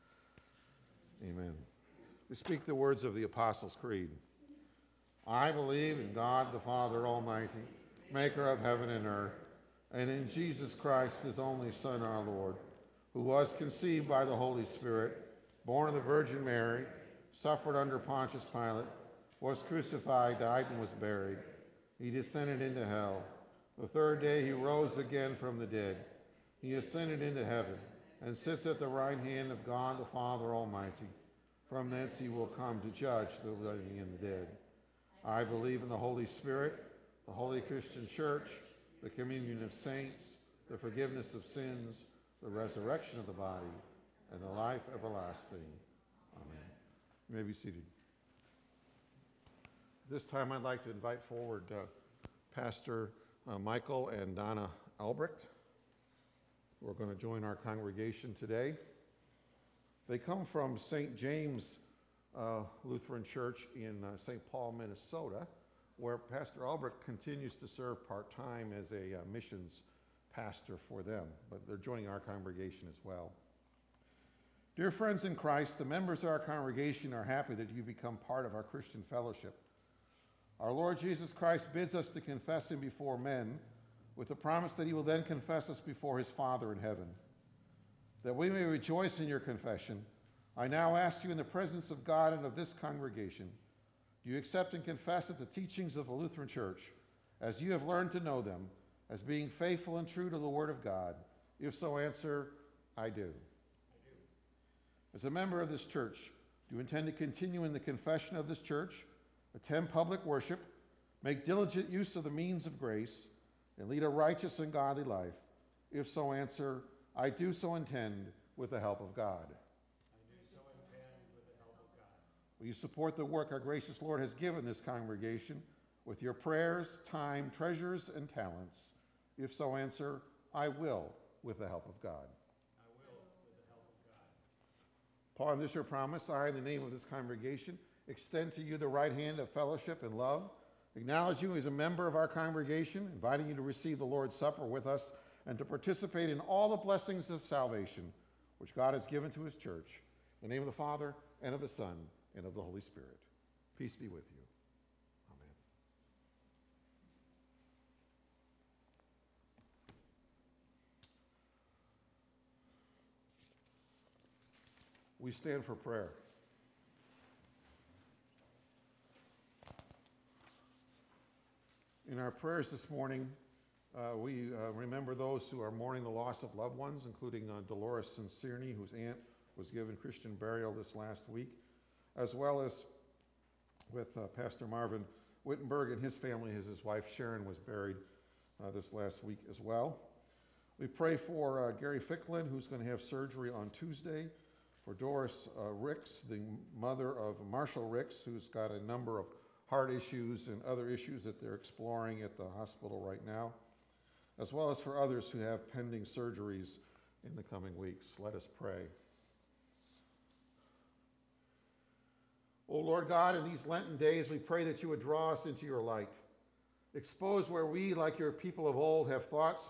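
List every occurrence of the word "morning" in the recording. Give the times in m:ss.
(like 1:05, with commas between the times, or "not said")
2:52.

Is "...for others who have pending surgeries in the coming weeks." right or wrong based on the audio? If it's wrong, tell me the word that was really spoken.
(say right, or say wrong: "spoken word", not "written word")
right.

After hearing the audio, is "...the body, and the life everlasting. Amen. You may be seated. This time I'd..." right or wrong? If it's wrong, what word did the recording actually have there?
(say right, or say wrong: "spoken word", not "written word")
right.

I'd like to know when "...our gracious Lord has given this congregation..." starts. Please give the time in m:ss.
2:03.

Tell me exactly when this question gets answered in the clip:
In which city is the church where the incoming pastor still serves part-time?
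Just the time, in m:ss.
1:04.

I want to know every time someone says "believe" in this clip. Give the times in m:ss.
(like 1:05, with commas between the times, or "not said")
0:05, 0:35.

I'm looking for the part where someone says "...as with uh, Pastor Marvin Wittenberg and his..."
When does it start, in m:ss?
3:02.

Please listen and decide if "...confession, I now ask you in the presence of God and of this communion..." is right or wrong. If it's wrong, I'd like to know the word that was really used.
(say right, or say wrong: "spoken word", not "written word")
wrong: "congregation", not "communion".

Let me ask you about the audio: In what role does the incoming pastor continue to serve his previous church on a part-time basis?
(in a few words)
missions pastor.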